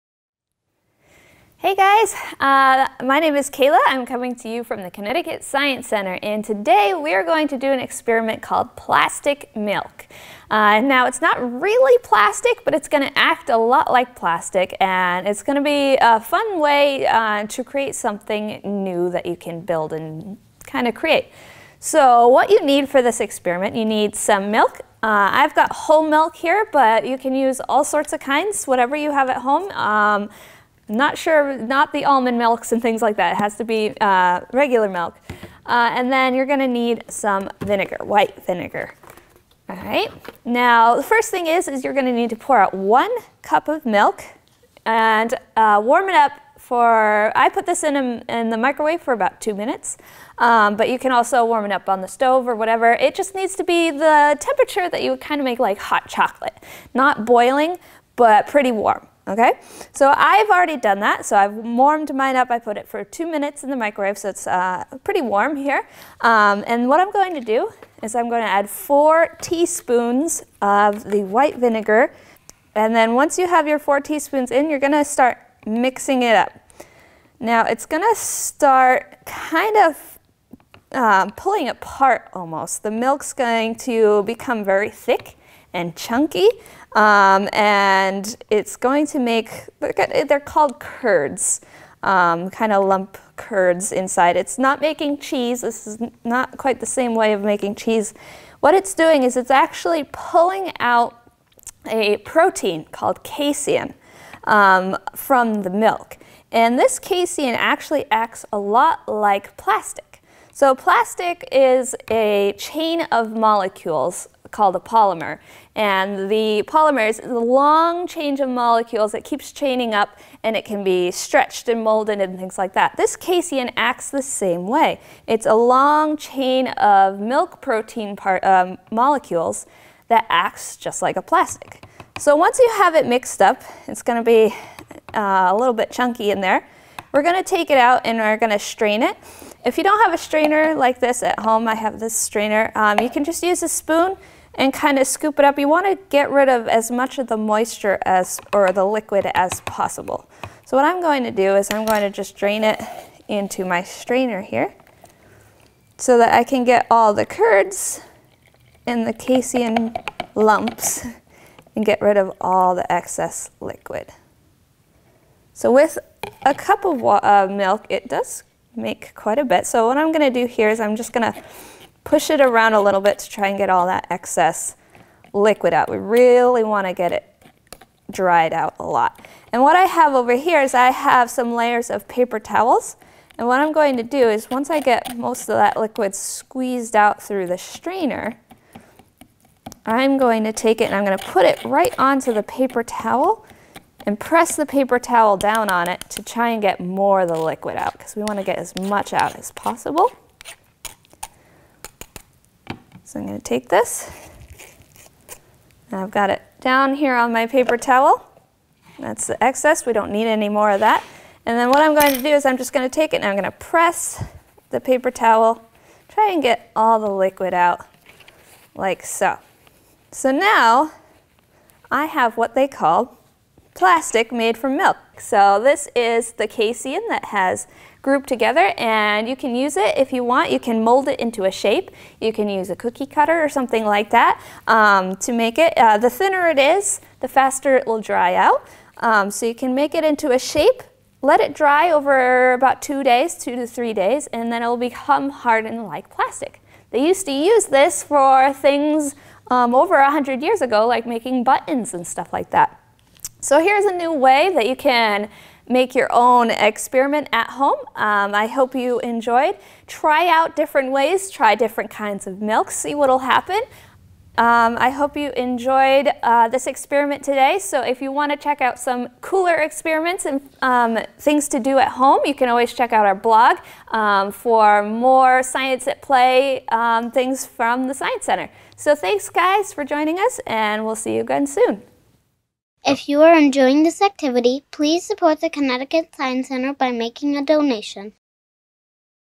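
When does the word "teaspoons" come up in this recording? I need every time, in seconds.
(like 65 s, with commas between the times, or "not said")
69 s, 73 s.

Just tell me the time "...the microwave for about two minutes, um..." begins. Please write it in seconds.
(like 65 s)
48 s.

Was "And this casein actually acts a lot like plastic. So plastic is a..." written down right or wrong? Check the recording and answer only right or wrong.
right.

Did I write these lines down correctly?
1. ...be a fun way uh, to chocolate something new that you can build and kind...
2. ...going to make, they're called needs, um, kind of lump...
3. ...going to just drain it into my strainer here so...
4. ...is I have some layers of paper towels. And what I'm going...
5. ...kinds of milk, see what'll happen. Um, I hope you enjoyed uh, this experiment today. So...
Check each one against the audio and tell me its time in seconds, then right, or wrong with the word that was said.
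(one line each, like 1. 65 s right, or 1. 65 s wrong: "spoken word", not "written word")
1. 15 s wrong: "create", not "chocolate"
2. 88 s wrong: "curds", not "needs"
3. 151 s right
4. 180 s right
5. 261 s right.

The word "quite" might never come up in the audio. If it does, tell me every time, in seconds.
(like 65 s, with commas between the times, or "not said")
96 s, 169 s.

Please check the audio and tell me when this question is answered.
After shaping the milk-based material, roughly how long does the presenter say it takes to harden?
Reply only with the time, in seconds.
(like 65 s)
243 s.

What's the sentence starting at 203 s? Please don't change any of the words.
So I'm going to take this, and I've got it down here on my paper towel.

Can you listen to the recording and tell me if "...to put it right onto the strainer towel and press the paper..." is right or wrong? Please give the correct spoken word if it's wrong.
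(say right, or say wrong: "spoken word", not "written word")
wrong: "paper", not "strainer".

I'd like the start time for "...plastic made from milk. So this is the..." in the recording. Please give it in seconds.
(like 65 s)
223 s.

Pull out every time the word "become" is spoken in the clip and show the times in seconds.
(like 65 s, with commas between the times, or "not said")
84 s, 244 s.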